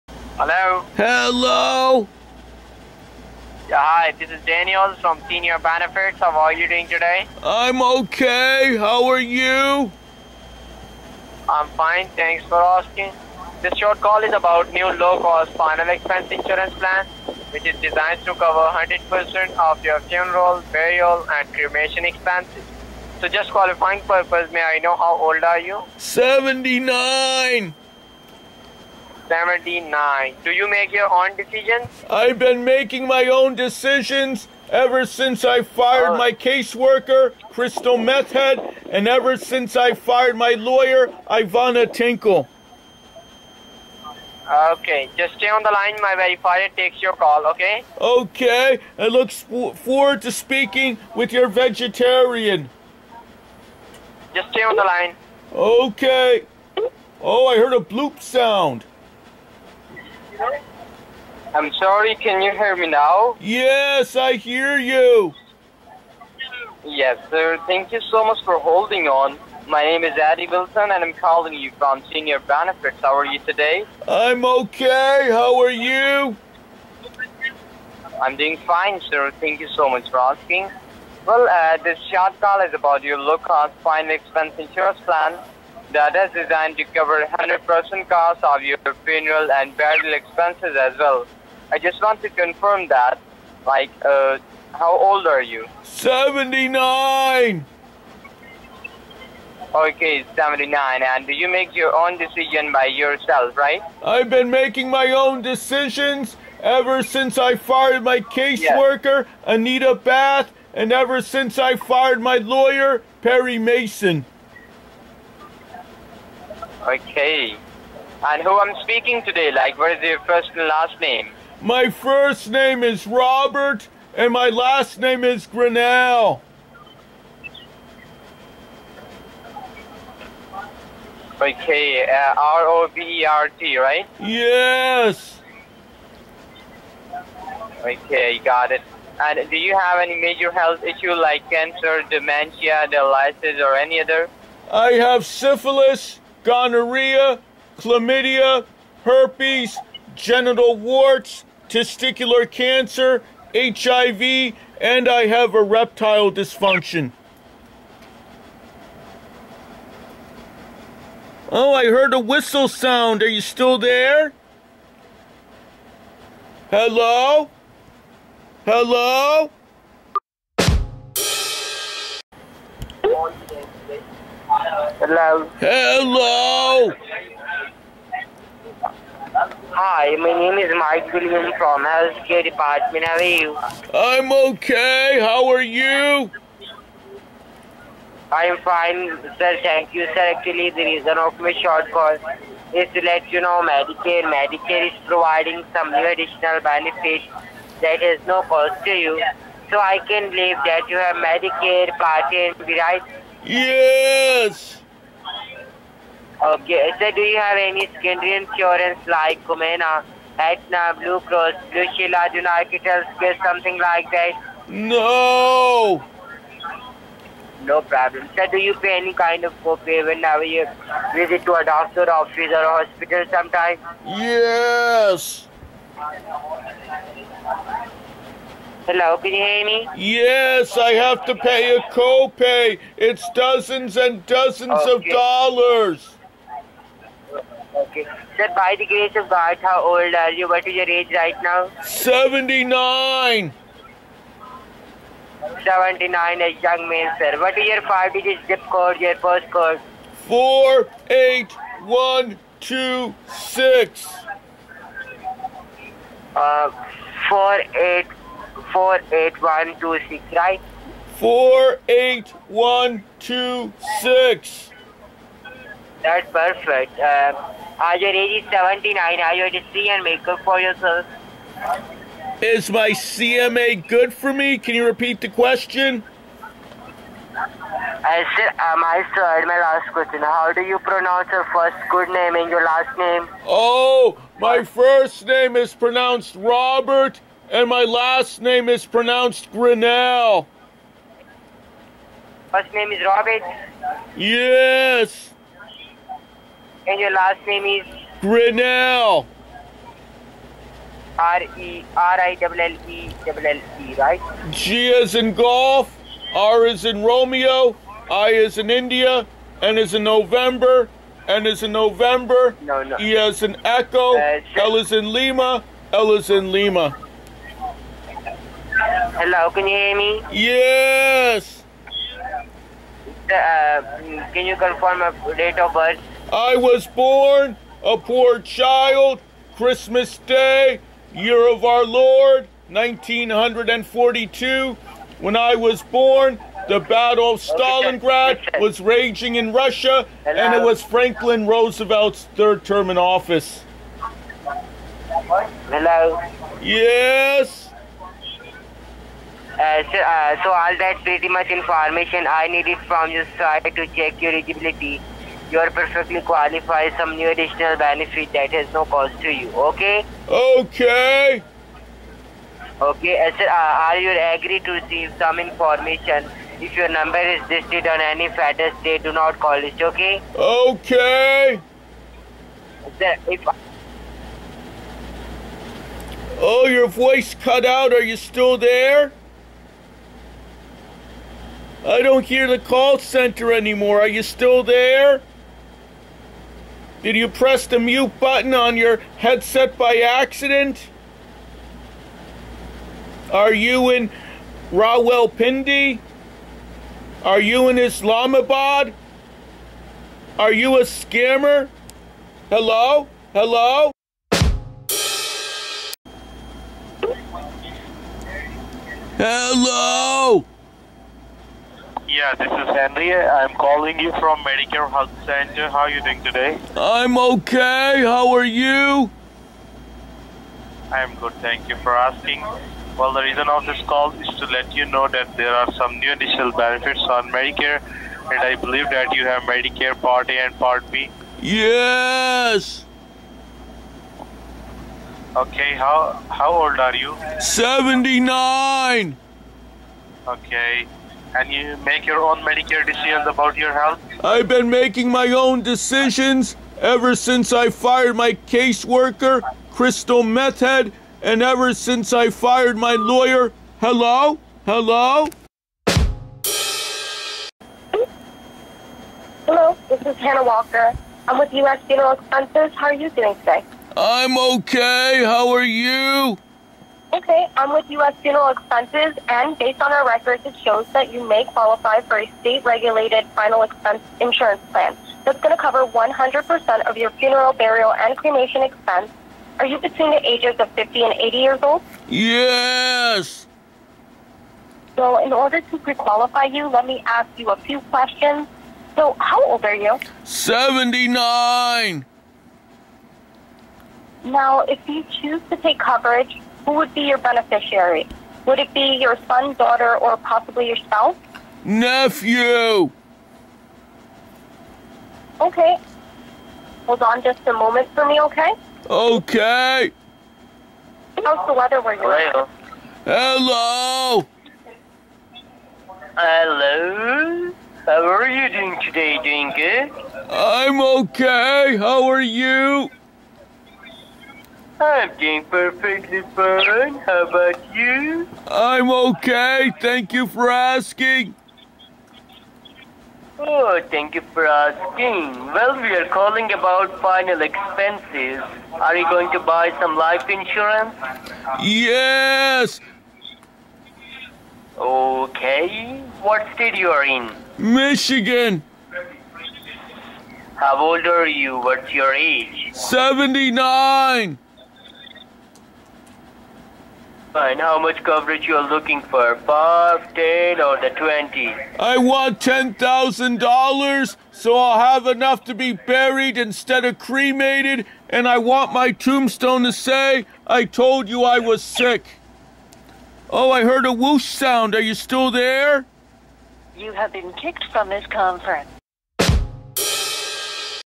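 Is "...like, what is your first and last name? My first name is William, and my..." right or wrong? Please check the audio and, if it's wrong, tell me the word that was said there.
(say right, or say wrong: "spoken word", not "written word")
wrong: "Robert", not "William".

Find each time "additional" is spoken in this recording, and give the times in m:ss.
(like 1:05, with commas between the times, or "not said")
3:16, 5:57, 7:06.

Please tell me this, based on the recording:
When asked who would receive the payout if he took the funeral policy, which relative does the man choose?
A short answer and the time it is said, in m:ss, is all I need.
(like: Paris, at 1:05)
Nephew, at 8:21.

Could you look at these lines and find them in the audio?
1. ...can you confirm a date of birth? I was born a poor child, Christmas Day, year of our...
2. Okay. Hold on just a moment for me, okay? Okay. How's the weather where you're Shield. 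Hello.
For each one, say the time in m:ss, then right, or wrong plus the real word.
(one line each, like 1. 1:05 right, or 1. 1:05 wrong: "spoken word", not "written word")
1. 5:24 right
2. 8:25 wrong: "Hello", not "Shield".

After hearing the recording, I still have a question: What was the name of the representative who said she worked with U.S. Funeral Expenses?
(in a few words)
Hannah Walker.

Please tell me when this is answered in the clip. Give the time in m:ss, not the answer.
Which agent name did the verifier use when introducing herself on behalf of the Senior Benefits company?
1:10.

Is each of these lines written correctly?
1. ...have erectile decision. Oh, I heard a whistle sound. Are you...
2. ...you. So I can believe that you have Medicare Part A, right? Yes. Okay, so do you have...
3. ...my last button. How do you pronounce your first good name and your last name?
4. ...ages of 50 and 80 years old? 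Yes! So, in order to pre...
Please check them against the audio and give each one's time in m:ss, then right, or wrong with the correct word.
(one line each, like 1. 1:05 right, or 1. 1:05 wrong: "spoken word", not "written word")
1. 2:35 wrong: "dysfunction", not "decision"
2. 3:18 right
3. 4:39 wrong: "question", not "button"
4. 8:00 right.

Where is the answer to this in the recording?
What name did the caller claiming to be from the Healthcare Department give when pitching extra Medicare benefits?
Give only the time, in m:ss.
3:00.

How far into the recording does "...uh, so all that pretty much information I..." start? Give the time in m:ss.
5:49.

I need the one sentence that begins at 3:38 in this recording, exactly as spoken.
Sir, do you pay any kind of copay whenever you visit to a doctor office or hospital sometimes?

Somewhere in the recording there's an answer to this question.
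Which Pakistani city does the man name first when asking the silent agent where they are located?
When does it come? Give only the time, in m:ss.
6:34.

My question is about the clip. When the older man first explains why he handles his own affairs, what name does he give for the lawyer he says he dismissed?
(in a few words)
Ivana Tinkle.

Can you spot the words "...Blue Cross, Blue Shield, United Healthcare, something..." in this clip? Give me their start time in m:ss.
3:30.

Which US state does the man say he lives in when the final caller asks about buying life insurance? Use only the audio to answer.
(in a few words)
Michigan.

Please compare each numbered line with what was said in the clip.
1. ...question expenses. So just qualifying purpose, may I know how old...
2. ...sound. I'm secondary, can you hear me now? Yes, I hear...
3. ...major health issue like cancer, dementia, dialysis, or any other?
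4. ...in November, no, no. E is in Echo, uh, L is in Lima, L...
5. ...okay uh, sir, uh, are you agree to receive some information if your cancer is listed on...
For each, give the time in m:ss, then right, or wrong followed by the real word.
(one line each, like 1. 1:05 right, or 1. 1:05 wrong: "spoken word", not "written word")
1. 0:21 wrong: "cremation", not "question"
2. 0:58 wrong: "sorry", not "secondary"
3. 2:20 right
4. 5:11 right
5. 6:02 wrong: "number", not "cancer".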